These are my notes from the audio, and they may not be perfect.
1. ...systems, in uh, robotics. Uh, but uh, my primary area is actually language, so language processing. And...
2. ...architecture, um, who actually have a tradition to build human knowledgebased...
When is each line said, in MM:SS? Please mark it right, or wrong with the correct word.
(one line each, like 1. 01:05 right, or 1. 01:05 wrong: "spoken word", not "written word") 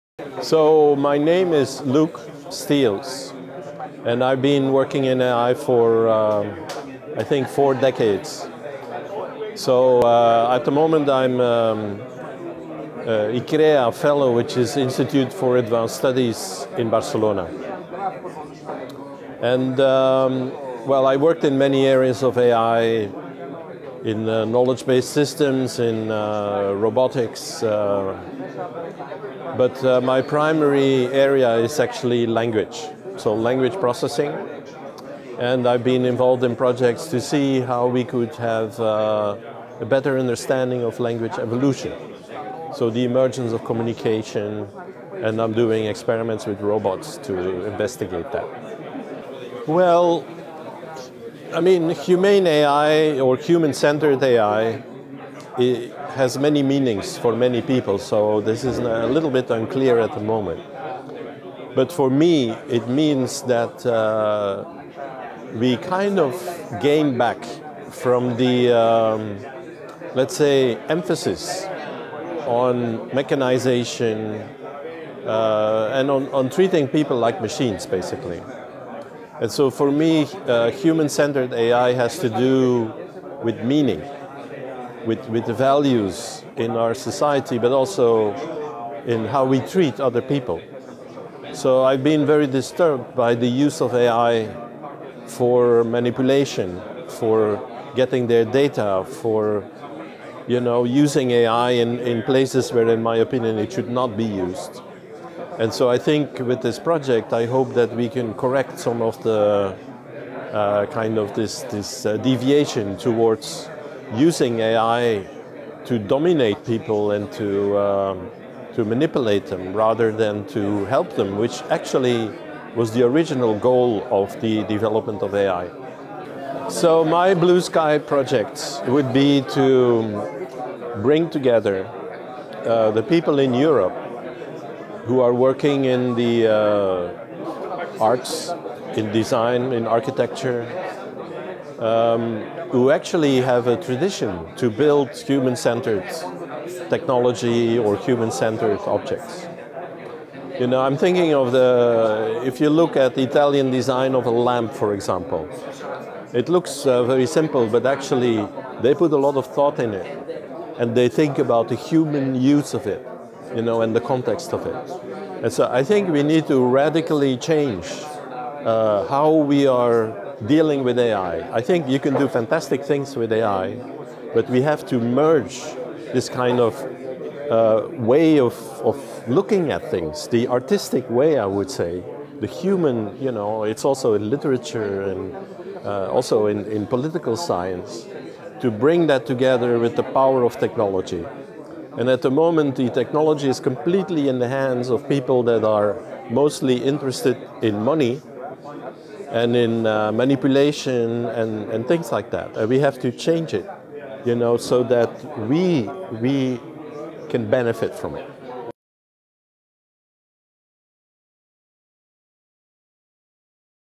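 1. 00:25 right
2. 02:19 wrong: "centered", not "knowledgebased".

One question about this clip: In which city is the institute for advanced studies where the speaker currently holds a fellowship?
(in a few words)
Barcelona.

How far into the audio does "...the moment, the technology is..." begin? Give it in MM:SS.
03:12.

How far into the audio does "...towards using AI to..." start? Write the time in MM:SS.
01:52.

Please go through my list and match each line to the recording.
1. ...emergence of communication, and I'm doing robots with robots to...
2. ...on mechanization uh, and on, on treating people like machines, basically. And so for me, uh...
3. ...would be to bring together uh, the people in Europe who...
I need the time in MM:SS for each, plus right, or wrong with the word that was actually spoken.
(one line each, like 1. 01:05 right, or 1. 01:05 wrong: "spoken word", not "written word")
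1. 00:43 wrong: "experiments", not "robots"
2. 01:12 right
3. 02:08 right.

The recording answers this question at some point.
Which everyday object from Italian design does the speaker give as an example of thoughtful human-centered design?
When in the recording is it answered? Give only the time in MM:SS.
02:34.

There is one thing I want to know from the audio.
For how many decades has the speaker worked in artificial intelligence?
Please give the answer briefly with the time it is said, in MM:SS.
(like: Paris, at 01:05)
4, at 00:07.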